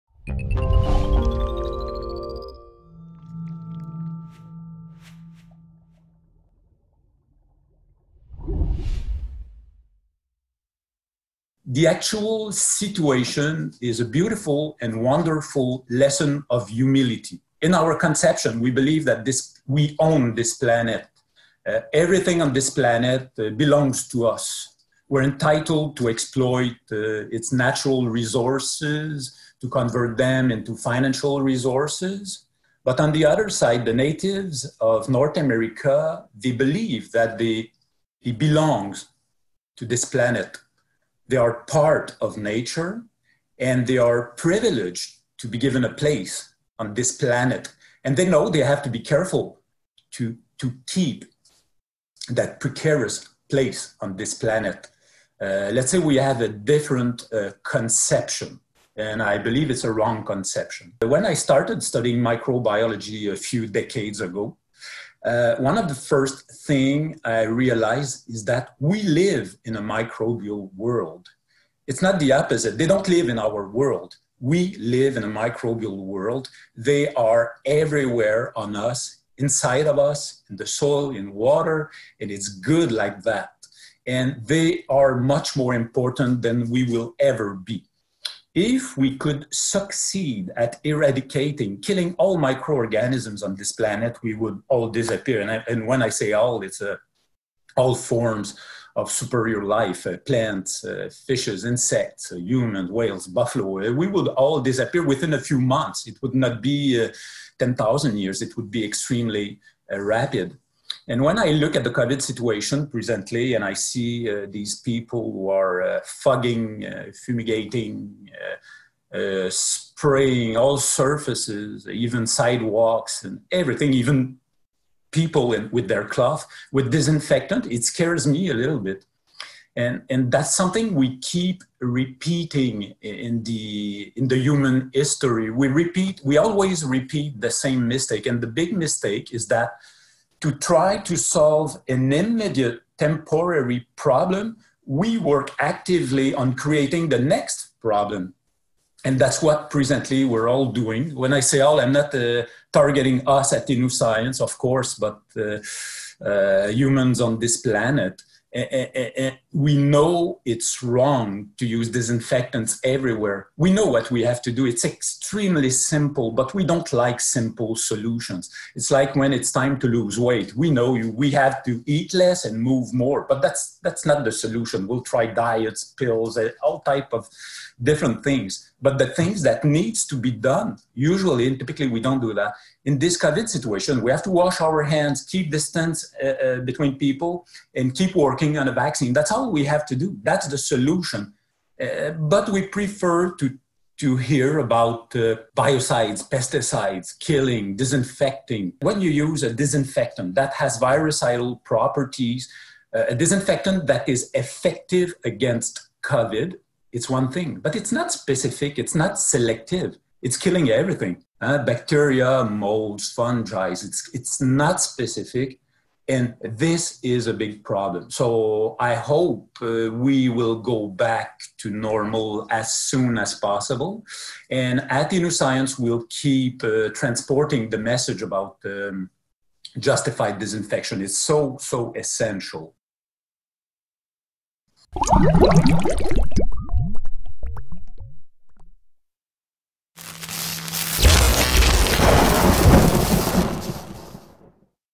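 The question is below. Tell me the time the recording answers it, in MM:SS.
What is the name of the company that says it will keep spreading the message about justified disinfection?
03:45.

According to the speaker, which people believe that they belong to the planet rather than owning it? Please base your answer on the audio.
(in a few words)
Natives of North America.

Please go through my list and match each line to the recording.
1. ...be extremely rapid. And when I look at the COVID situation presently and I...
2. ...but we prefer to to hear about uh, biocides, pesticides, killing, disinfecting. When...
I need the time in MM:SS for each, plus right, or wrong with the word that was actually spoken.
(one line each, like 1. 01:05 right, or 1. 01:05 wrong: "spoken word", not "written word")
1. 01:48 right
2. 03:12 right.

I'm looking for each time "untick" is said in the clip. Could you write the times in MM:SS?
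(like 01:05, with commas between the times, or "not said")
not said.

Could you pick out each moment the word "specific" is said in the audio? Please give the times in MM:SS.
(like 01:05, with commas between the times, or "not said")
03:28, 03:34.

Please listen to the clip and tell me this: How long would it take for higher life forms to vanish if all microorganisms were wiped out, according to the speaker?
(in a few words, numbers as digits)
A few months.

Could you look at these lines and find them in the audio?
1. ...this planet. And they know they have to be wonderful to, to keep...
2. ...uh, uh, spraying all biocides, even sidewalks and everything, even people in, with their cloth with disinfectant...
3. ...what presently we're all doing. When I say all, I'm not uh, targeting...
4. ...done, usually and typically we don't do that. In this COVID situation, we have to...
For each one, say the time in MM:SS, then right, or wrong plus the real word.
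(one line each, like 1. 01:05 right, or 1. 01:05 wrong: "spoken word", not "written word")
1. 00:46 wrong: "careful", not "wonderful"
2. 01:58 wrong: "surfaces", not "biocides"
3. 02:29 right
4. 03:00 right.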